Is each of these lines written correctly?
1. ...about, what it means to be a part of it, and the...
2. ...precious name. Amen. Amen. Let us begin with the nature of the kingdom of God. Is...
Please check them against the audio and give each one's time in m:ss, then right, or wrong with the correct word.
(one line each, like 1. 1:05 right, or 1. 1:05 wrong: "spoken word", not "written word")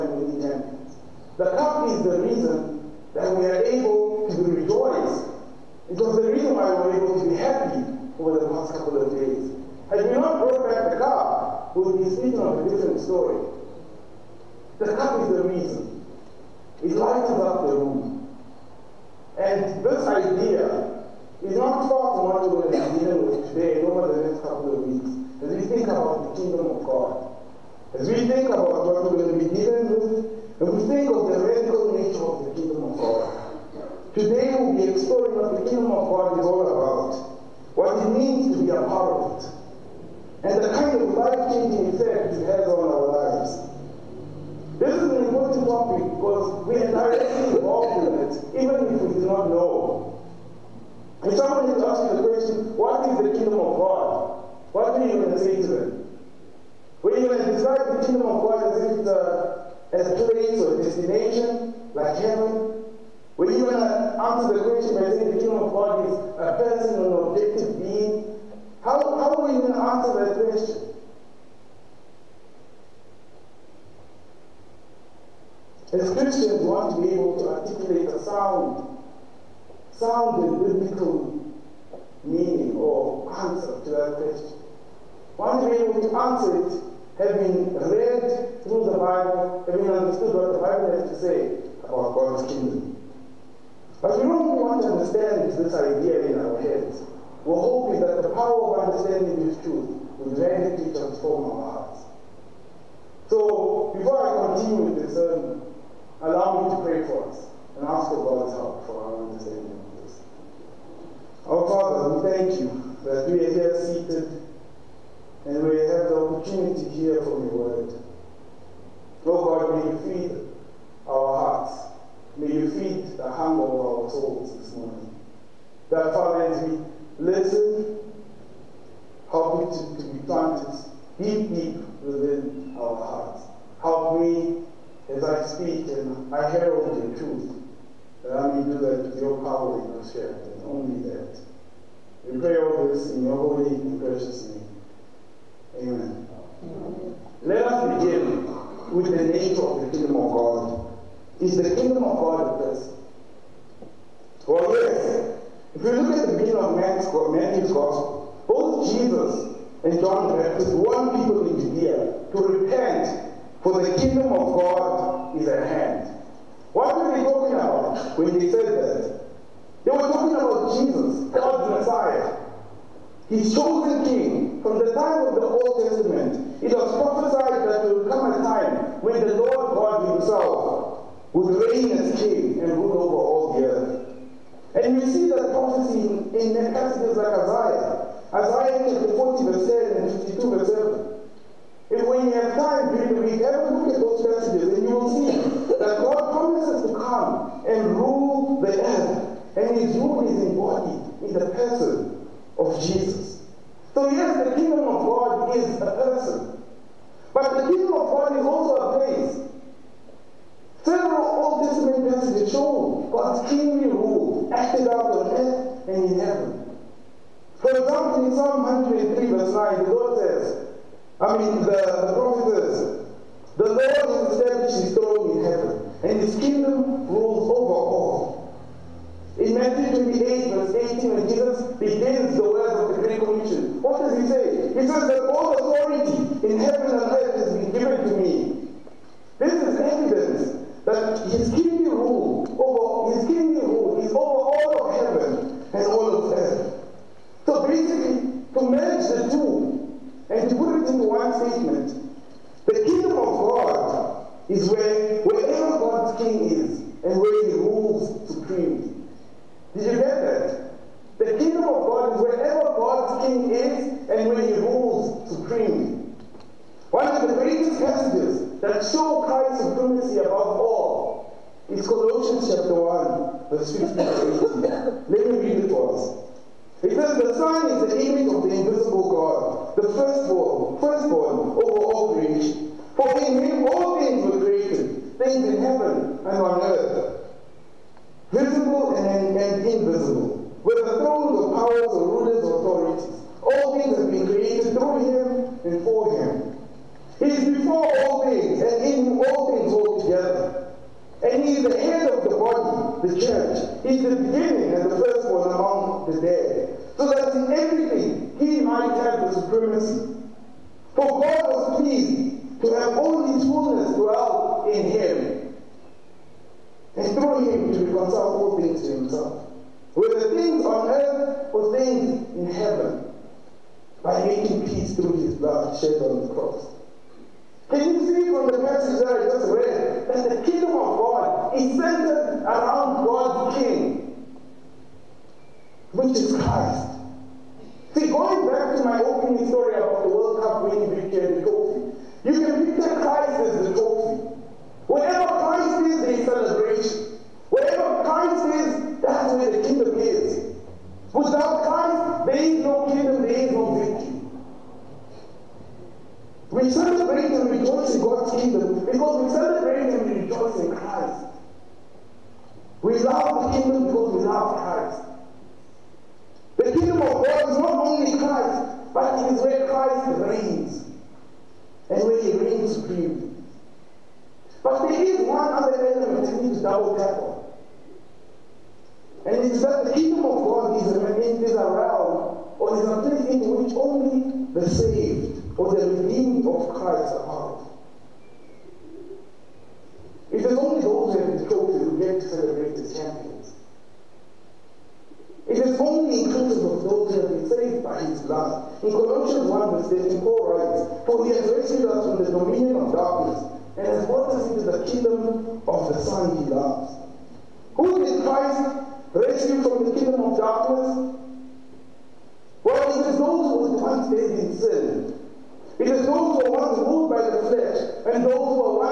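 1. 0:36 right
2. 2:23 right.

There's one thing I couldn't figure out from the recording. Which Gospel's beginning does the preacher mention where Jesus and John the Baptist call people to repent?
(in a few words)
Matthew.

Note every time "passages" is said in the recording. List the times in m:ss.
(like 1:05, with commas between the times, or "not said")
3:14, 3:32, 5:28.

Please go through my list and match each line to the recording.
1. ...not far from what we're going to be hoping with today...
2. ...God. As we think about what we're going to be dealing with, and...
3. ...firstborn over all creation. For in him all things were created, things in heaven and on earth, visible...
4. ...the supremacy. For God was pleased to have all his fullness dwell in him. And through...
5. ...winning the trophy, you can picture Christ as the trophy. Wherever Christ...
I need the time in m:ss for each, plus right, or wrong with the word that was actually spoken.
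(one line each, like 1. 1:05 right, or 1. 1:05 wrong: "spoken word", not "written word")
1. 0:21 wrong: "dealing", not "hoping"
2. 0:26 right
3. 4:40 right
4. 5:09 right
5. 5:40 right.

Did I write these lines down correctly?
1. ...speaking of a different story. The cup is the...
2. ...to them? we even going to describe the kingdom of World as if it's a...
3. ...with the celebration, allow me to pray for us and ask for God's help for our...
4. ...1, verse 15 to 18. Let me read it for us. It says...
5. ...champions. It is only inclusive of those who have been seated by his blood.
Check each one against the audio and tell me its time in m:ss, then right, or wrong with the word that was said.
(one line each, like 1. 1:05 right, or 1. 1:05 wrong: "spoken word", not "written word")
1. 0:12 right
2. 0:55 wrong: "God", not "World"
3. 1:44 wrong: "sermon", not "celebration"
4. 4:32 right
5. 6:32 wrong: "saved", not "seated".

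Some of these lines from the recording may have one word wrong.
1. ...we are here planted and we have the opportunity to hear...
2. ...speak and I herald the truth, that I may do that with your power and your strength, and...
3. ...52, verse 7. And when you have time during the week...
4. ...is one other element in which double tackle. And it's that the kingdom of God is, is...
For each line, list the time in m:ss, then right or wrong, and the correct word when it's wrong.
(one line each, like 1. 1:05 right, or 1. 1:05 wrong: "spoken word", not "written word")
1. 1:53 wrong: "seated", not "planted"
2. 2:15 right
3. 3:10 right
4. 6:15 right.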